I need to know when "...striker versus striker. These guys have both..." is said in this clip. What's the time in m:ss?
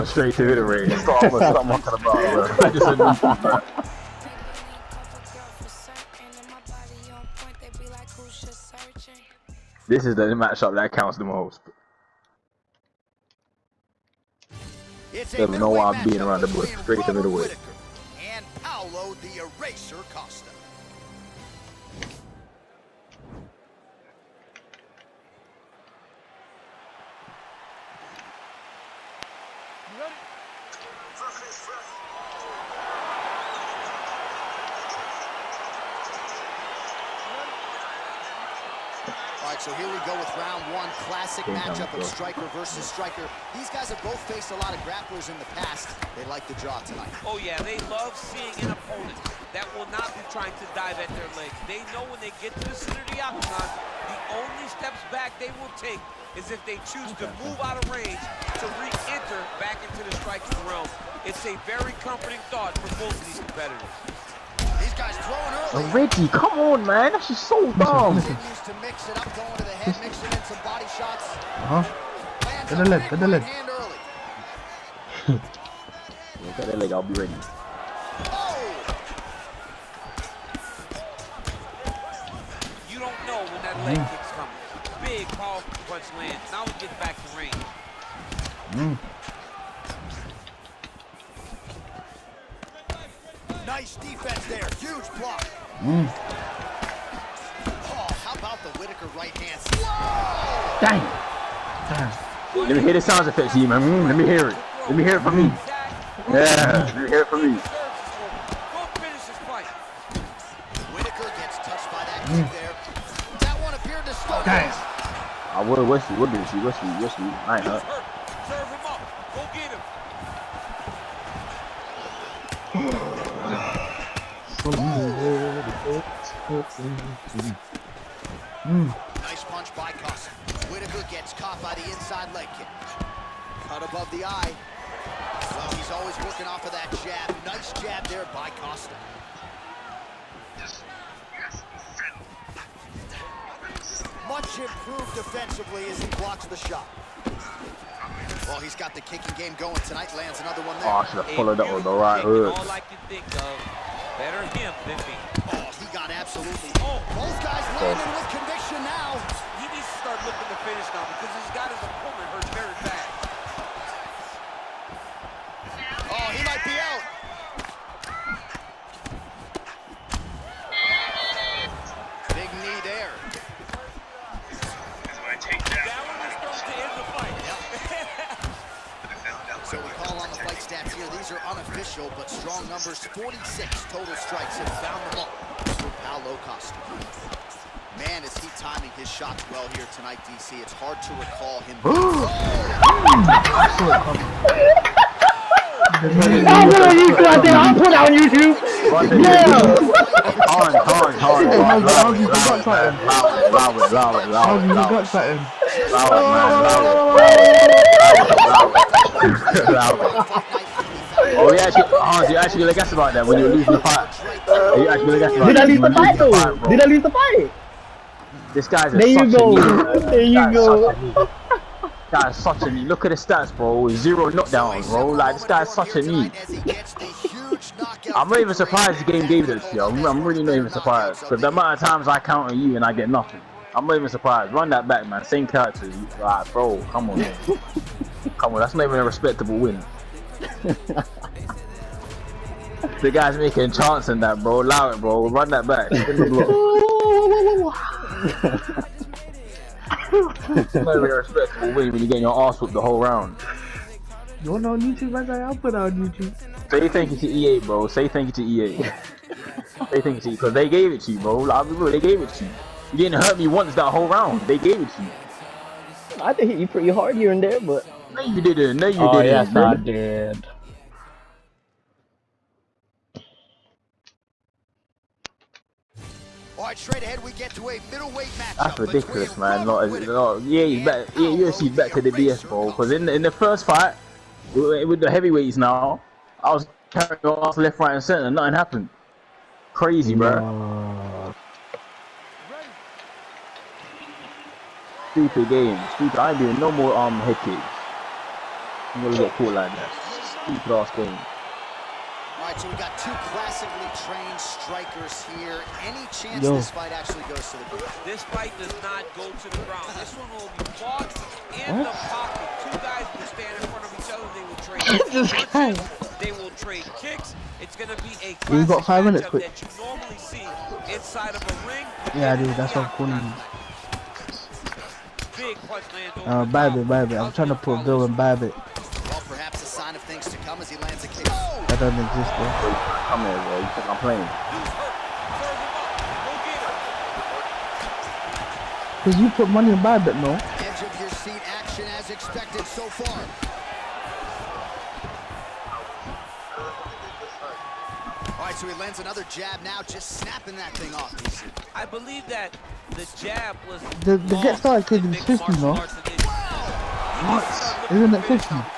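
0:42.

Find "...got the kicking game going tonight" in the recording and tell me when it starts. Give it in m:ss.
2:28.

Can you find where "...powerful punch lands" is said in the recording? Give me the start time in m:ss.
1:25.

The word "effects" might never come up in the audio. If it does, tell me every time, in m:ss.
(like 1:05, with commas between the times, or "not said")
1:43.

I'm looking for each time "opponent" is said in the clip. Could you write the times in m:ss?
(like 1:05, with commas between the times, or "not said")
0:48, 2:41.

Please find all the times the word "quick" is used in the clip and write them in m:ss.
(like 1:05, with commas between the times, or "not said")
5:19.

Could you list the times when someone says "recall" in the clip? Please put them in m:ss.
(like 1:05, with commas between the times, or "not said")
3:11.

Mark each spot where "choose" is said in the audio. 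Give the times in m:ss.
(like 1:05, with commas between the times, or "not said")
0:56.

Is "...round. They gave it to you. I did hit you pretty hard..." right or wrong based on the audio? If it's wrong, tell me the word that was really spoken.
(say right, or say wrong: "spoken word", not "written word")
right.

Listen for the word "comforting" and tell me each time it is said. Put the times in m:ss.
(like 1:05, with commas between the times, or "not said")
1:02.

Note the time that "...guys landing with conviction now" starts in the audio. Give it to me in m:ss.
2:37.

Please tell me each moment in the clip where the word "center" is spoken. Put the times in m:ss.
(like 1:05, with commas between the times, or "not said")
0:52, 4:48.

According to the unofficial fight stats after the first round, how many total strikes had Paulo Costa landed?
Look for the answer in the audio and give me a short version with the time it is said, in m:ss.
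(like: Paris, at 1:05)
46, at 3:03.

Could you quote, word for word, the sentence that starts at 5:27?
I'm trying to put Bill and Babbitt doesn't exist there.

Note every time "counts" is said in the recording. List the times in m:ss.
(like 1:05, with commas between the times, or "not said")
0:10, 3:52.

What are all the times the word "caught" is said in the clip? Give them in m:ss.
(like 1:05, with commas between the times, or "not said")
2:11, 4:59.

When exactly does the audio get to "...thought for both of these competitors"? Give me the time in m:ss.
1:02.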